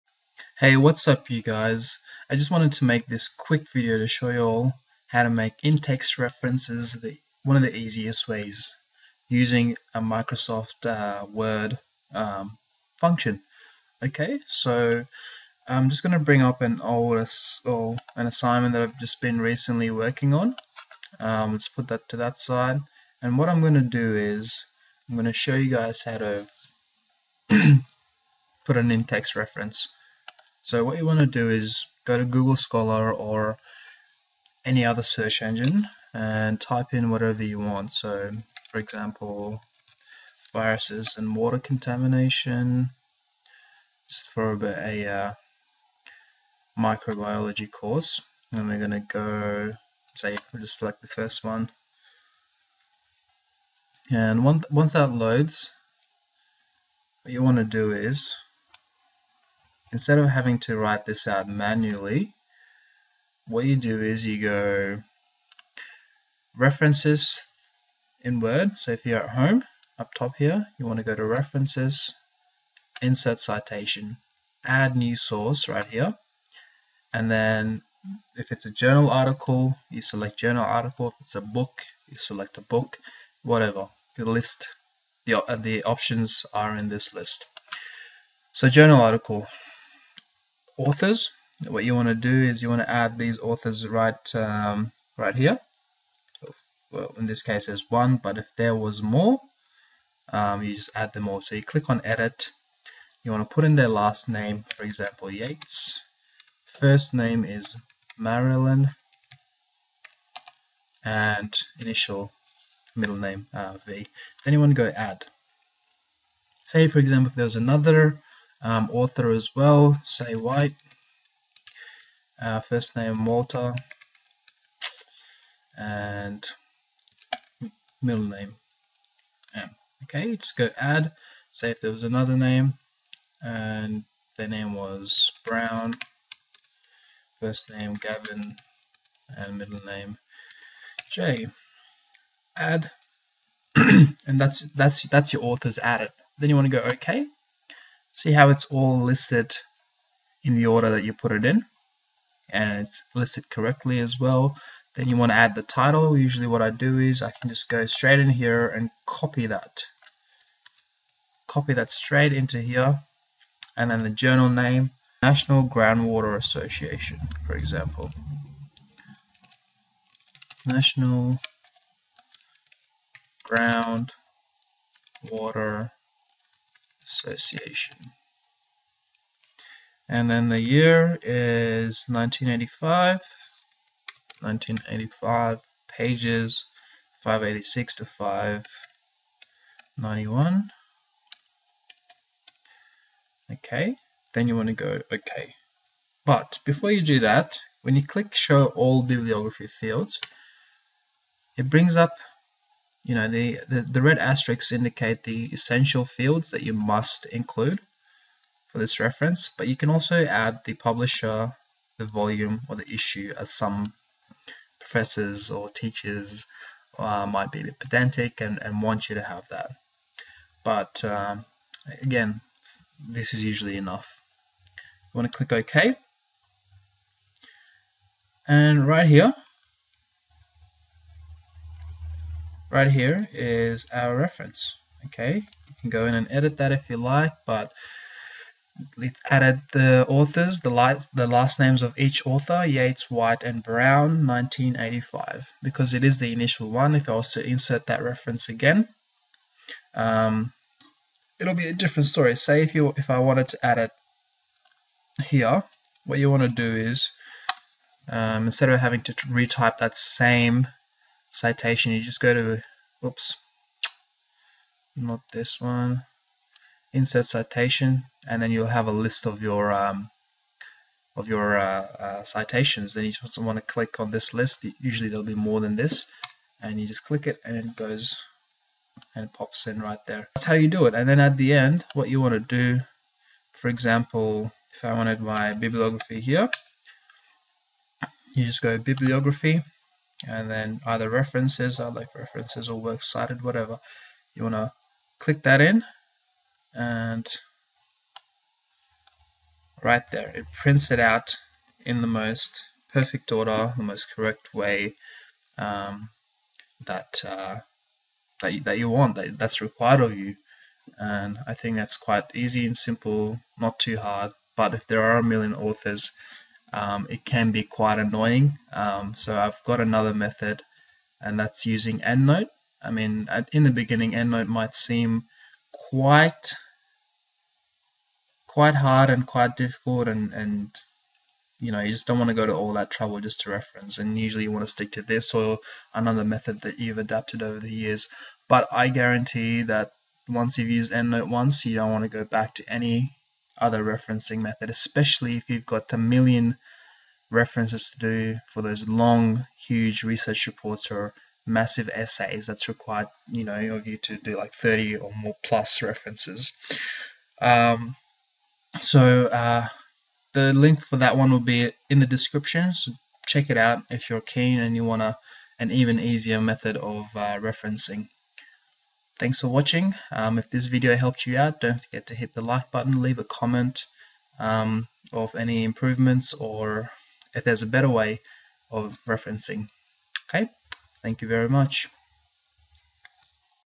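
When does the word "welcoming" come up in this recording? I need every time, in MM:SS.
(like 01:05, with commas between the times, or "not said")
not said.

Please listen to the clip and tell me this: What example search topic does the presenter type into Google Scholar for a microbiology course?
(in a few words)
Viruses and water contamination.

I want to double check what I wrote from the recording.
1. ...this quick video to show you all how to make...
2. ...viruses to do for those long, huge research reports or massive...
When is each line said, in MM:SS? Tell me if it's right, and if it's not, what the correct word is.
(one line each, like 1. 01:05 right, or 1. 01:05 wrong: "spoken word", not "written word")
1. 00:03 right
2. 05:47 wrong: "references", not "viruses".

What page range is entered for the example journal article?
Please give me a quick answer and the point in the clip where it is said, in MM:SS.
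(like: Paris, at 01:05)
586 to 591, at 03:07.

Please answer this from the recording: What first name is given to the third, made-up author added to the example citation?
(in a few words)
Gavin.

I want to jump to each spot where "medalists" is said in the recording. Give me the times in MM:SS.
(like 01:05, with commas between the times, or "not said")
not said.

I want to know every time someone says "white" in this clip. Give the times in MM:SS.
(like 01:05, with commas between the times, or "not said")
02:00, 04:03.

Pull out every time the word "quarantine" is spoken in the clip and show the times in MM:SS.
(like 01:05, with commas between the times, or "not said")
not said.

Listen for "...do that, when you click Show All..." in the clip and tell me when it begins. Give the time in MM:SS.
03:17.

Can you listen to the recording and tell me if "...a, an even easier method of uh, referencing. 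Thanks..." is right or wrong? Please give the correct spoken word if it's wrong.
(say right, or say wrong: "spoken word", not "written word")
right.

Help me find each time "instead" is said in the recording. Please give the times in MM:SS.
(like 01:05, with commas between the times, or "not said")
00:59, 04:18.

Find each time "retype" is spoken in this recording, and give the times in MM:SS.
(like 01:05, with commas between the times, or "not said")
04:19.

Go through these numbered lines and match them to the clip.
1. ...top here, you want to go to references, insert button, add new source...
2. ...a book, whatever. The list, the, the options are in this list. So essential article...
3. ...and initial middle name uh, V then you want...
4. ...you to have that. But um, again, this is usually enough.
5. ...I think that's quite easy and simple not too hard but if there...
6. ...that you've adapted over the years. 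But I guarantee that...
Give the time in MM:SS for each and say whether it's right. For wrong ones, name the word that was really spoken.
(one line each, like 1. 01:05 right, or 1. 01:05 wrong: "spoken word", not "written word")
1. 01:10 wrong: "citation", not "button"
2. 01:22 wrong: "journal", not "essential"
3. 01:51 right
4. 03:39 right
5. 05:11 right
6. 05:36 right.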